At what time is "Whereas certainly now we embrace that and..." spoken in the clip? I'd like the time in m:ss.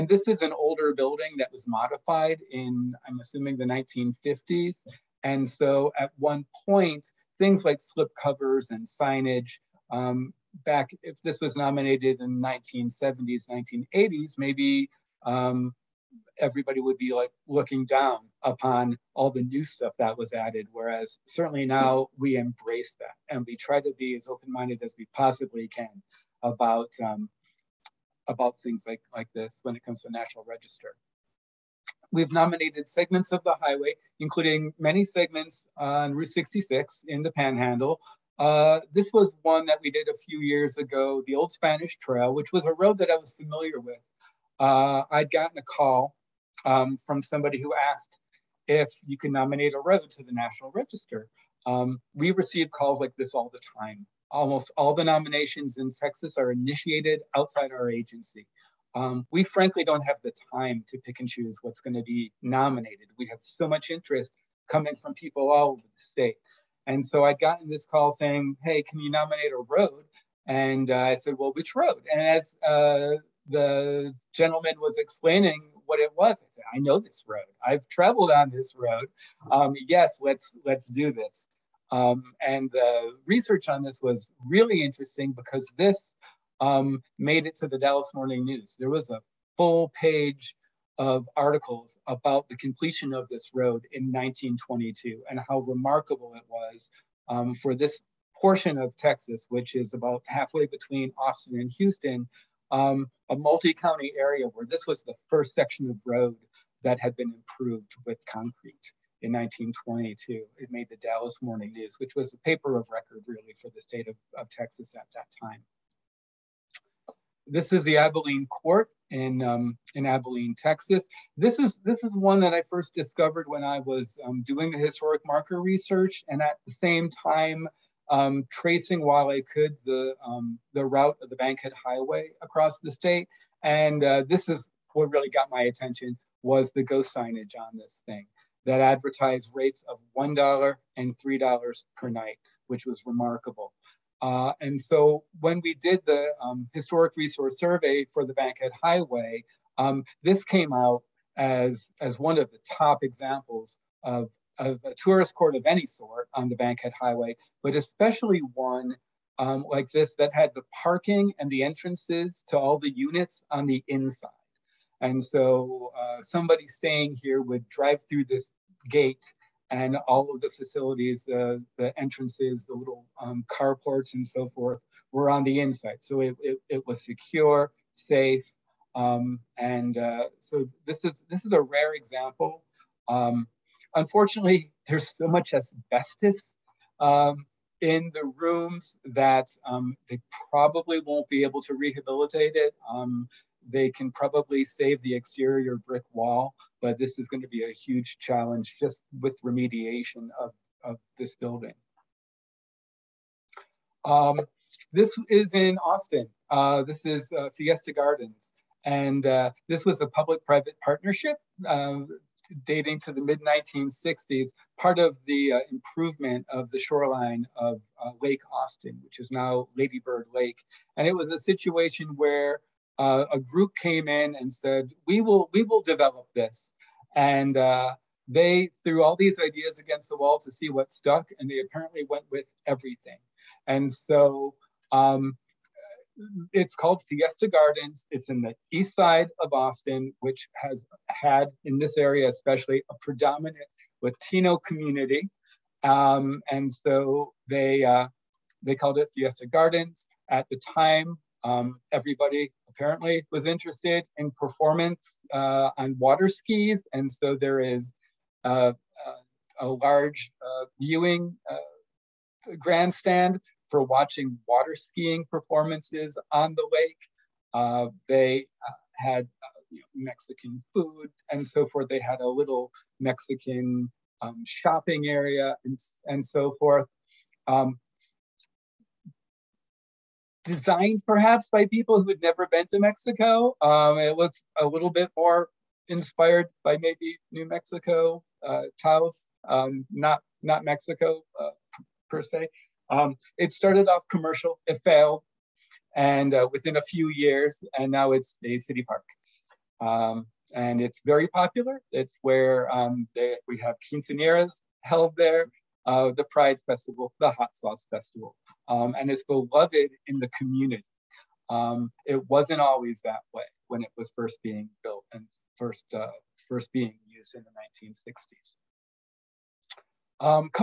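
0:20.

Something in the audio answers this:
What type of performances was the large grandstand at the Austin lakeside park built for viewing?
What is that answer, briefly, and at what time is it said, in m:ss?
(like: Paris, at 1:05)
Water skiing, at 4:24.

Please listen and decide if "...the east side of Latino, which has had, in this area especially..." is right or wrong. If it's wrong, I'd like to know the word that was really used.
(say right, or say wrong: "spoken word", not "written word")
wrong: "Austin", not "Latino".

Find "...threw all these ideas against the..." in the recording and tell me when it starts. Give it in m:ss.
3:48.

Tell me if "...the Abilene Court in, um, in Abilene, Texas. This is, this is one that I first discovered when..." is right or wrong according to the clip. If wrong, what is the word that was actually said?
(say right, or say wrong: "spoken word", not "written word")
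right.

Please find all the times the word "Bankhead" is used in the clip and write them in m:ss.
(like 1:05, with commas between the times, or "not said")
2:11, 2:28, 2:36.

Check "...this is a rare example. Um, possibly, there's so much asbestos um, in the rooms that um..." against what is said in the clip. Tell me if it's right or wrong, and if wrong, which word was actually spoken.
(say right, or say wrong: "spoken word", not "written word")
wrong: "unfortunately", not "possibly".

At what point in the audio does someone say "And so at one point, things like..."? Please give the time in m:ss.
0:05.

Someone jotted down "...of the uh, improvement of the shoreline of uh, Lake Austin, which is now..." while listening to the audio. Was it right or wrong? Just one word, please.
right.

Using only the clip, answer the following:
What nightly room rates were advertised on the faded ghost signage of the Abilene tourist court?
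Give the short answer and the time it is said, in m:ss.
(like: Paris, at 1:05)
$1 and $3, at 2:20.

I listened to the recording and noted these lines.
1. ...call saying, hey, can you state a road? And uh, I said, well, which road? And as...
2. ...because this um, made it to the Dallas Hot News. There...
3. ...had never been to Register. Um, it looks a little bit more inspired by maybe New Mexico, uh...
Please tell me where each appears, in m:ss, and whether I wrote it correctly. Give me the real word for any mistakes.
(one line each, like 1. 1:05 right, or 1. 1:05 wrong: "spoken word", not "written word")
1. 1:07 wrong: "nominate", not "state"
2. 1:25 wrong: "Morning", not "Hot"
3. 4:42 wrong: "Mexico", not "Register".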